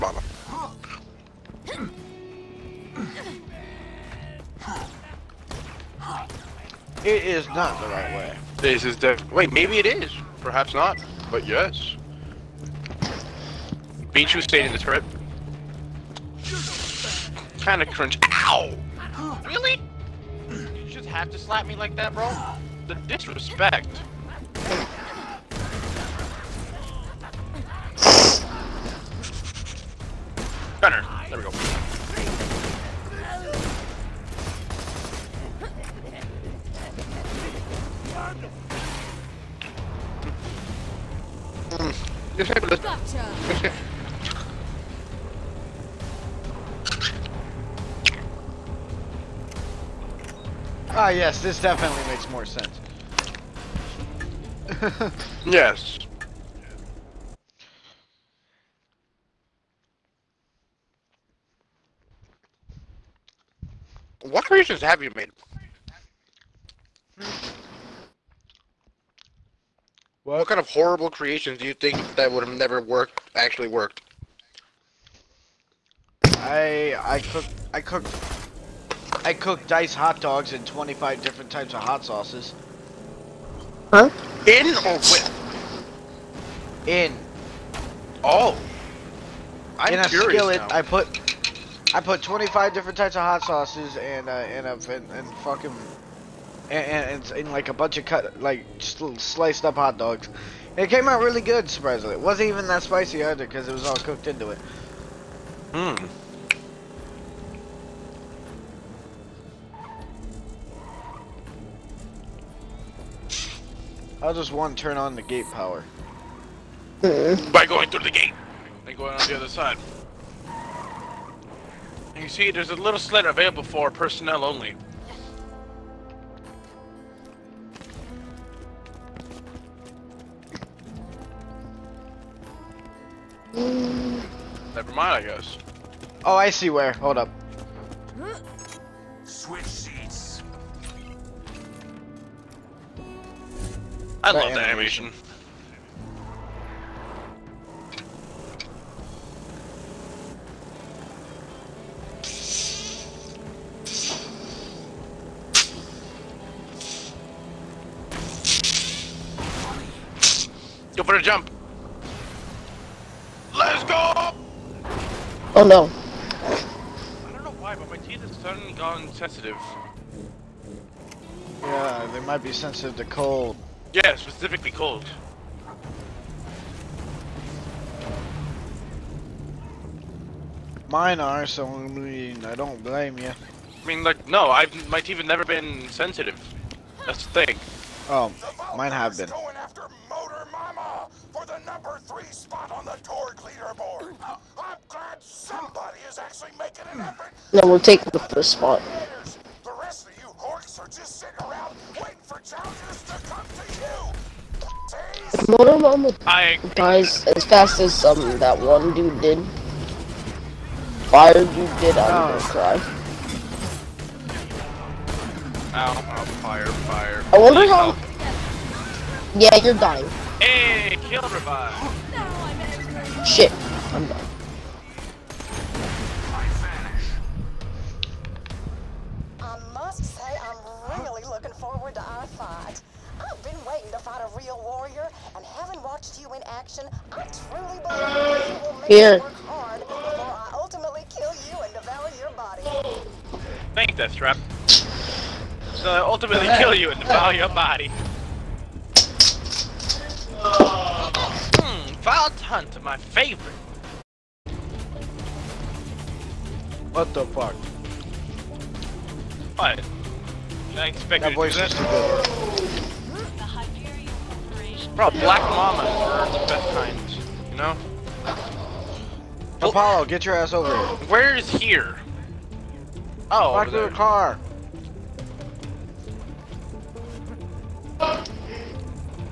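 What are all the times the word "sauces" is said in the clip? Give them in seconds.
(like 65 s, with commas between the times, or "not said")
82 s, 93 s.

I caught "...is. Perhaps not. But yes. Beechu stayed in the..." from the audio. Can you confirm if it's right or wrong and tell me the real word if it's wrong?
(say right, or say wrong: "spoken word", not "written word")
right.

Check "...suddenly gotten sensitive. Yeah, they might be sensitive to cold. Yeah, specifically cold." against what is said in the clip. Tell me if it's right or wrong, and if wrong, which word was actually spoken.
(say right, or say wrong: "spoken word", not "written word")
right.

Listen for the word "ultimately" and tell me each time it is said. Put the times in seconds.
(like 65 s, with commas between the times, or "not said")
240 s, 245 s.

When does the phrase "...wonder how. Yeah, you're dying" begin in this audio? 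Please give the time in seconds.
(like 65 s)
217 s.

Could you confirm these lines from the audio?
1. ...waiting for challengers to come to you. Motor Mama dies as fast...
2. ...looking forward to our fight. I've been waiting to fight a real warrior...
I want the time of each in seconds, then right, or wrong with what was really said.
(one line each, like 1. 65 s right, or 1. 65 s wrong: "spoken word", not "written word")
1. 201 s right
2. 231 s right.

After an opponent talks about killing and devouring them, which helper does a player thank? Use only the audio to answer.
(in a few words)
Deathtrap.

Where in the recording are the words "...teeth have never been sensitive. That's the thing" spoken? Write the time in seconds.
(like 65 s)
184 s.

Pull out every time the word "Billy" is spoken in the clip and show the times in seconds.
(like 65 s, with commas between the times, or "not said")
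not said.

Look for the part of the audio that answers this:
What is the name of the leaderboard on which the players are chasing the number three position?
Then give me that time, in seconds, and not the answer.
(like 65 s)
193 s.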